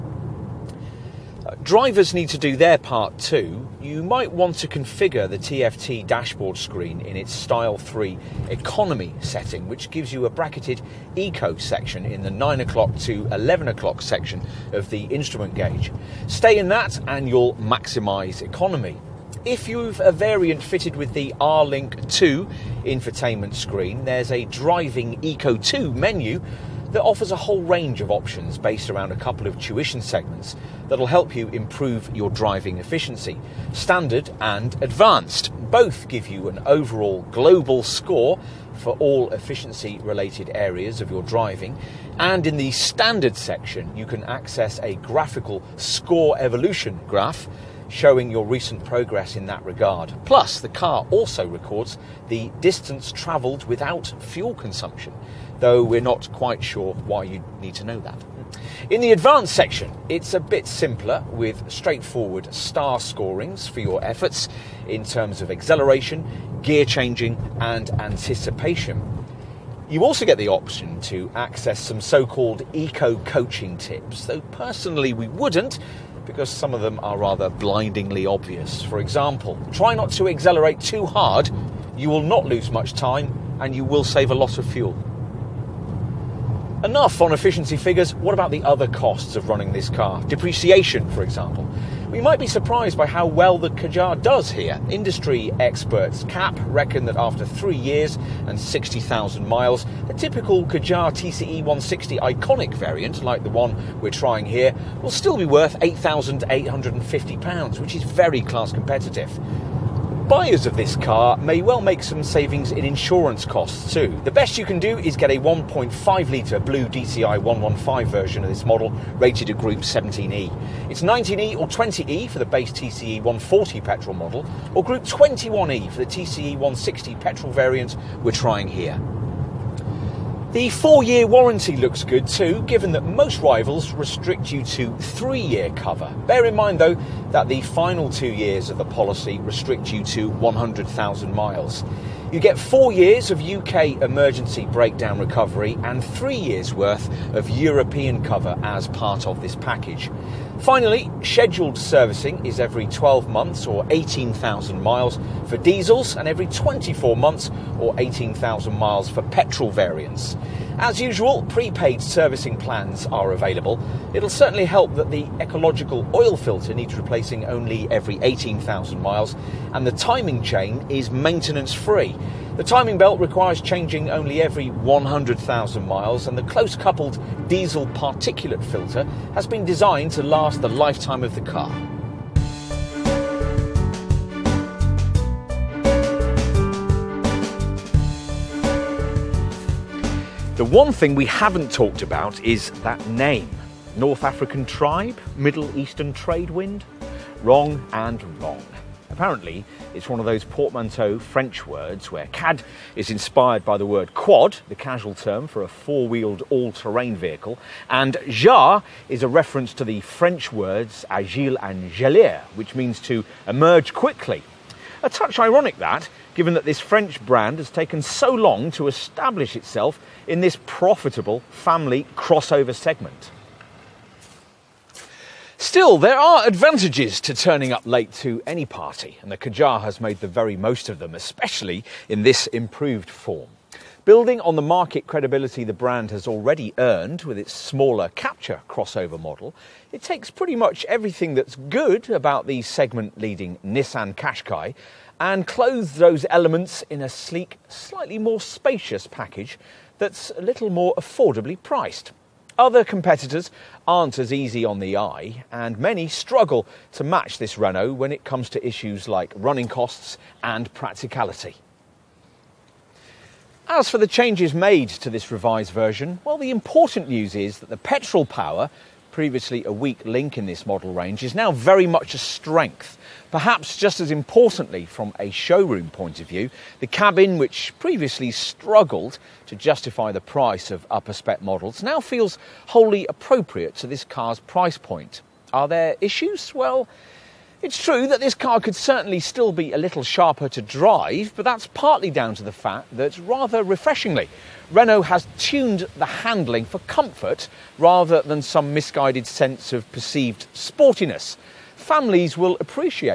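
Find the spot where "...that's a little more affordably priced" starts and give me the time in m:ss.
4:09.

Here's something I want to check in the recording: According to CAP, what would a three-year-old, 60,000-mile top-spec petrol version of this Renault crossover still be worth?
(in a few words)
£8,850.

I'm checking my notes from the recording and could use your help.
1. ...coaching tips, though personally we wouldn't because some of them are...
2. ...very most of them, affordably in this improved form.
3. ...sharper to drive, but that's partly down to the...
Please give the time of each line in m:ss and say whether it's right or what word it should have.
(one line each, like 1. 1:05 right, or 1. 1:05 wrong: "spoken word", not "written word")
1. 1:13 right
2. 3:50 wrong: "especially", not "affordably"
3. 4:50 right.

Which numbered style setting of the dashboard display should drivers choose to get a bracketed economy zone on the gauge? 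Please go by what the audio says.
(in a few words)
Style 3.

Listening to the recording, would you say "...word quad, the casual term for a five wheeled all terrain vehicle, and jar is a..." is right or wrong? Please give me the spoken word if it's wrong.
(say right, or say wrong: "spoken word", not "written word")
wrong: "four", not "five".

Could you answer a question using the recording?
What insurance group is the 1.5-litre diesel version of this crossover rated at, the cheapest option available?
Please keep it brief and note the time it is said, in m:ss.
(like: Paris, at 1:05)
Group 17E, at 1:59.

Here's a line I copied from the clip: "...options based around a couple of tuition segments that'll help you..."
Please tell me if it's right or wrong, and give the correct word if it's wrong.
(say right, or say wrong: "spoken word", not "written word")
right.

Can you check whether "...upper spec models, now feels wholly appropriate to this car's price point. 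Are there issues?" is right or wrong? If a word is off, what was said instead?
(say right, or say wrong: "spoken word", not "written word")
right.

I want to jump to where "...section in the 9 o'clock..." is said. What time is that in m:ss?
0:11.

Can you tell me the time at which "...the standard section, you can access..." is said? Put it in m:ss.
0:42.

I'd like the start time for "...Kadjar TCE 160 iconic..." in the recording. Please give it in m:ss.
1:40.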